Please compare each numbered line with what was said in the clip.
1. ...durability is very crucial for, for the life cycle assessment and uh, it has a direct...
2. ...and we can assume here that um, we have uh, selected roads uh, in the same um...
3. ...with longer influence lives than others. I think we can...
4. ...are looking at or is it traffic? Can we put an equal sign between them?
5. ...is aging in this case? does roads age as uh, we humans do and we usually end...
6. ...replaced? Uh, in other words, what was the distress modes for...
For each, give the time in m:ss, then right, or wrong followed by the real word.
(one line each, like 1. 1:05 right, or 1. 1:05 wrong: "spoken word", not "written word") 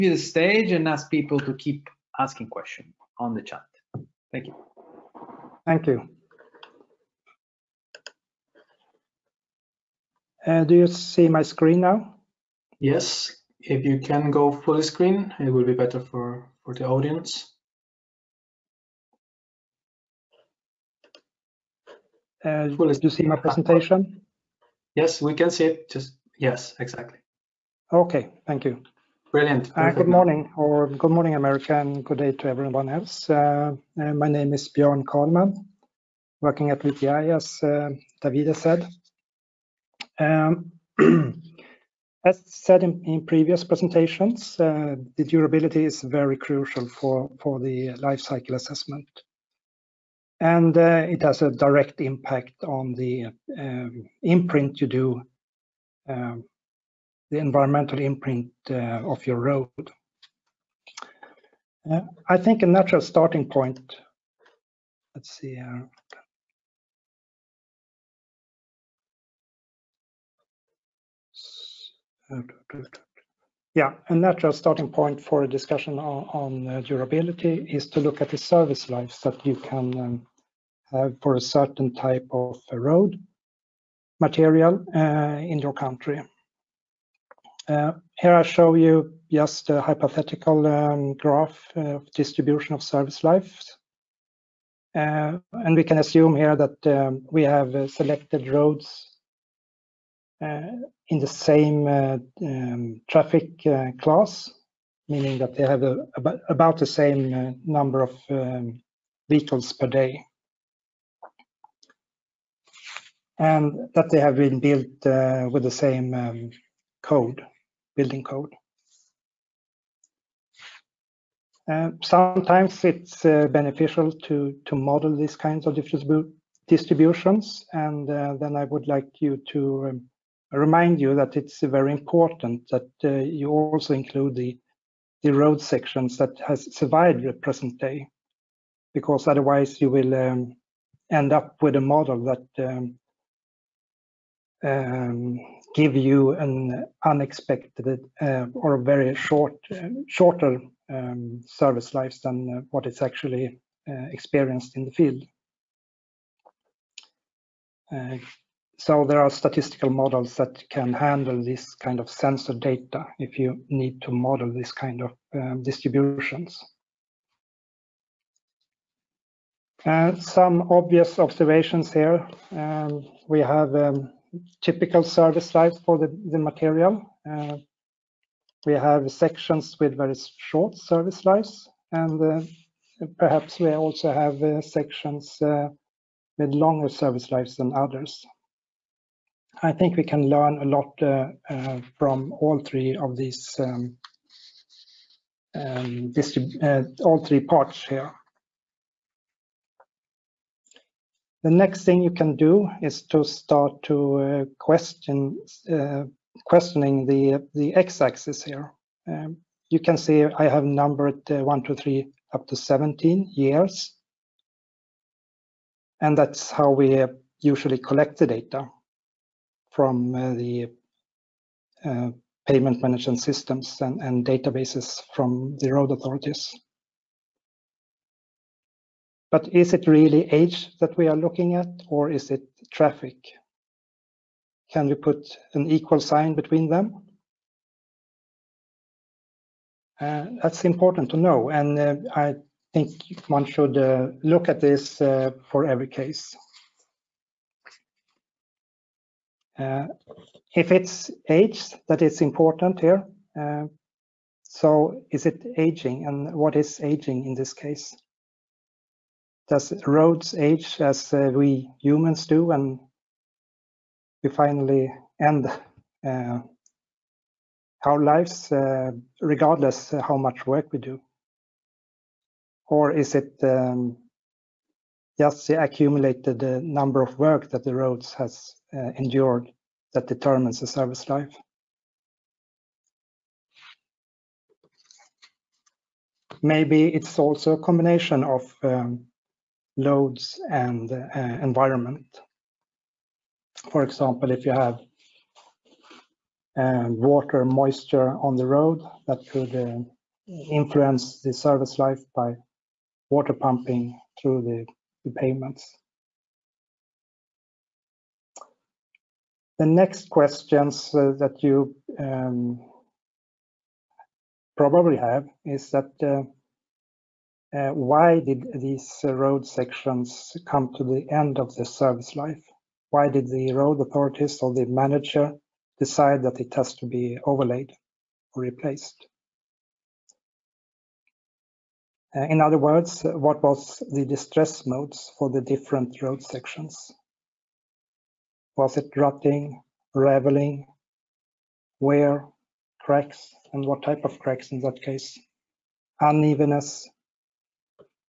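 1. 0:45 right
2. 1:35 right
3. 3:06 wrong: "service", not "influence"
4. 3:51 right
5. 4:16 wrong: "finally", not "usually"
6. 5:28 right.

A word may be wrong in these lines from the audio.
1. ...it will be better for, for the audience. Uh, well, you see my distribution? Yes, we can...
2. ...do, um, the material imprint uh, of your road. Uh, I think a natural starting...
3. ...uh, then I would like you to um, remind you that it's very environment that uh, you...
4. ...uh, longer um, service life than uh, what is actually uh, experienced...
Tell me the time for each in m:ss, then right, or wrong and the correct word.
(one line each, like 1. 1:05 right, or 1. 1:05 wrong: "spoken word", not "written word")
1. 0:15 wrong: "presentation", not "distribution"
2. 0:54 wrong: "environmental", not "material"
3. 2:08 wrong: "important", not "environment"
4. 2:29 wrong: "shorter", not "longer".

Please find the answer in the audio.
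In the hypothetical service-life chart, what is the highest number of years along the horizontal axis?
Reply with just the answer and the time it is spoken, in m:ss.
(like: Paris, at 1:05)
17, at 3:32.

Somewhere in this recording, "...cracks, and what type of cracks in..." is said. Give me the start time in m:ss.
5:42.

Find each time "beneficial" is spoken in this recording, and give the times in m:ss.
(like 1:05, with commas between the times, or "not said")
2:03.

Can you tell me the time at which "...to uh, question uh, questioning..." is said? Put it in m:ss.
3:23.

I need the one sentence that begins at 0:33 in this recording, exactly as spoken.
Uh, uh my name is Bjorn Karlman, working at VTI, as uh, Davida said.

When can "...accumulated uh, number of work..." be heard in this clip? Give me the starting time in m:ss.
4:35.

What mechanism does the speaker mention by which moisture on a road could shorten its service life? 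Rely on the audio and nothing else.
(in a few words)
water pumping.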